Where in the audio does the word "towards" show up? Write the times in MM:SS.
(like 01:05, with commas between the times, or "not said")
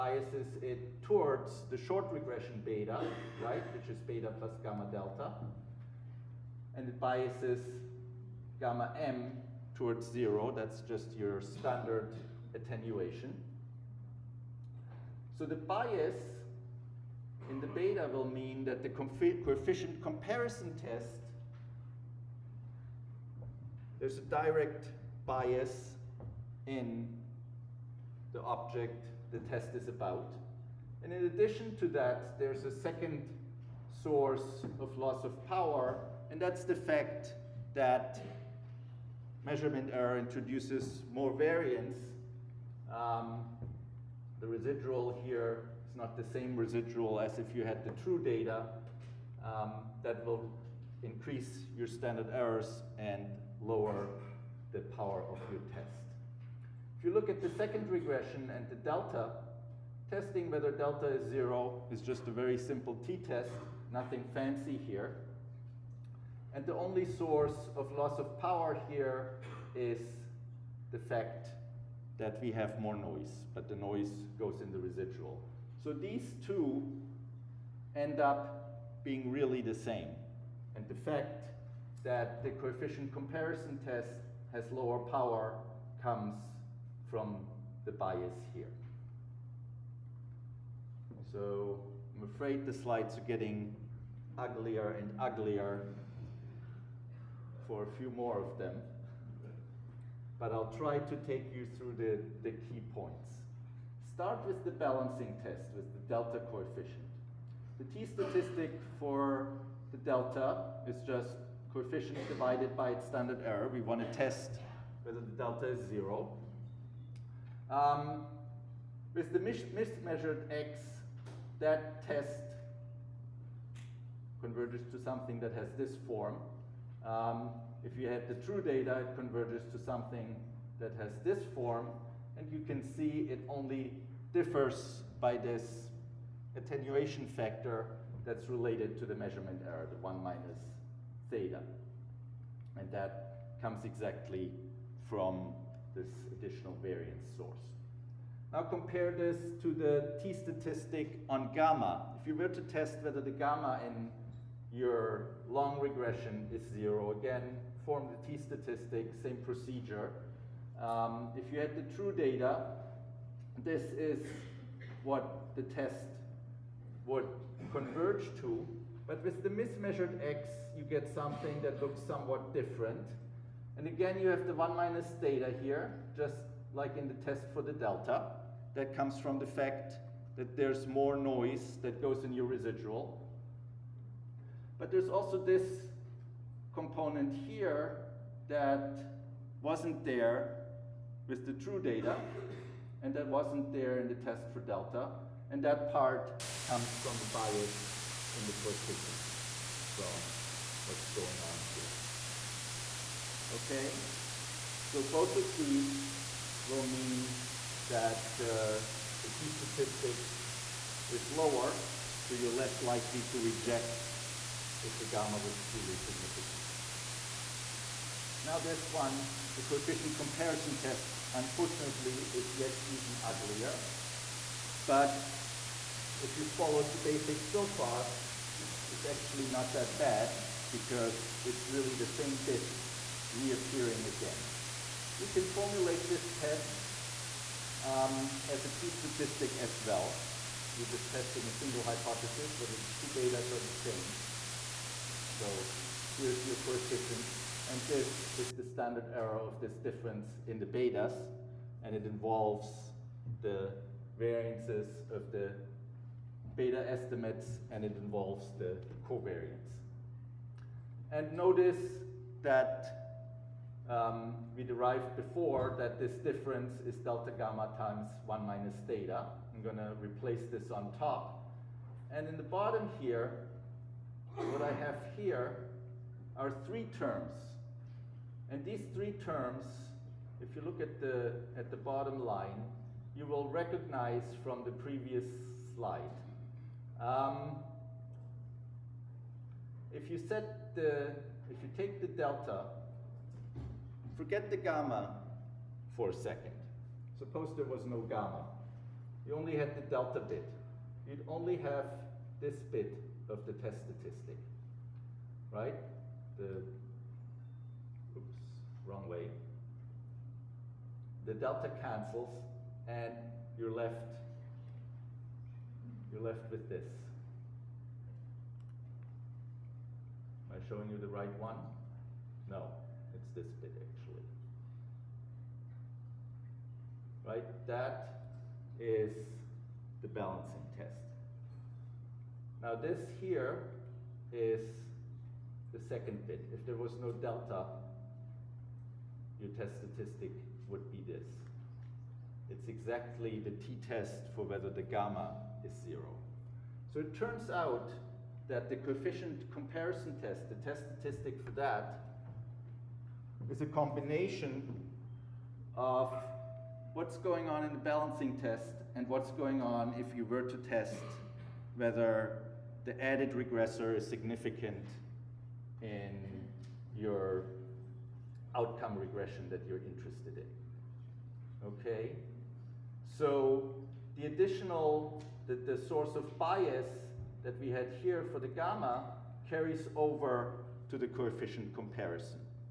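00:01, 00:09.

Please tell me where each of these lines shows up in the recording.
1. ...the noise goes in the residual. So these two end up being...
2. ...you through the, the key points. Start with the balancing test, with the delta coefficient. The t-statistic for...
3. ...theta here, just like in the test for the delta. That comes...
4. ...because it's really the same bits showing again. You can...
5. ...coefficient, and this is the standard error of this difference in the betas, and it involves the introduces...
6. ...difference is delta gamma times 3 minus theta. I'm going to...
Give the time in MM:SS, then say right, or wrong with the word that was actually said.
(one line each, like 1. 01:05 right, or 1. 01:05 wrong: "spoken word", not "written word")
1. 01:13 right
2. 01:41 right
3. 02:55 right
4. 03:50 wrong: "reappearing", not "showing"
5. 04:06 wrong: "variances", not "introduces"
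6. 04:26 wrong: "1", not "3".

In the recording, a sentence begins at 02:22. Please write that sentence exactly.
And that comes exactly from this additional variance source.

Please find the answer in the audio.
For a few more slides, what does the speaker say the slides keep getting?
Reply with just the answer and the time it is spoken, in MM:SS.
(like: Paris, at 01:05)
uglier and uglier, at 01:34.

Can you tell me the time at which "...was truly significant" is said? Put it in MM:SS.
03:35.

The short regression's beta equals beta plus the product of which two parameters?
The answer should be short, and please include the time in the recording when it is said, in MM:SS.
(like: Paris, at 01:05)
gamma delta, at 00:04.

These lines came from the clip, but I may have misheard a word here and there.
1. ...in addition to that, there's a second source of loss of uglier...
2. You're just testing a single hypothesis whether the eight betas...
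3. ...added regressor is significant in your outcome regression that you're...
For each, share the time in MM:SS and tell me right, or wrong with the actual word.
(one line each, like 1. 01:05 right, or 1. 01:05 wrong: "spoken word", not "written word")
1. 00:31 wrong: "power", not "uglier"
2. 04:00 wrong: "two", not "eight"
3. 06:03 right.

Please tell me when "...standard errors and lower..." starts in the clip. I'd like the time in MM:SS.
00:51.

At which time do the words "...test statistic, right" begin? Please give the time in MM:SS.
05:03.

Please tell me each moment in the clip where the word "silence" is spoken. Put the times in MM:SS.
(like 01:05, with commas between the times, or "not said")
not said.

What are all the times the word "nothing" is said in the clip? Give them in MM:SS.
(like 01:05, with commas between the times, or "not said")
01:03.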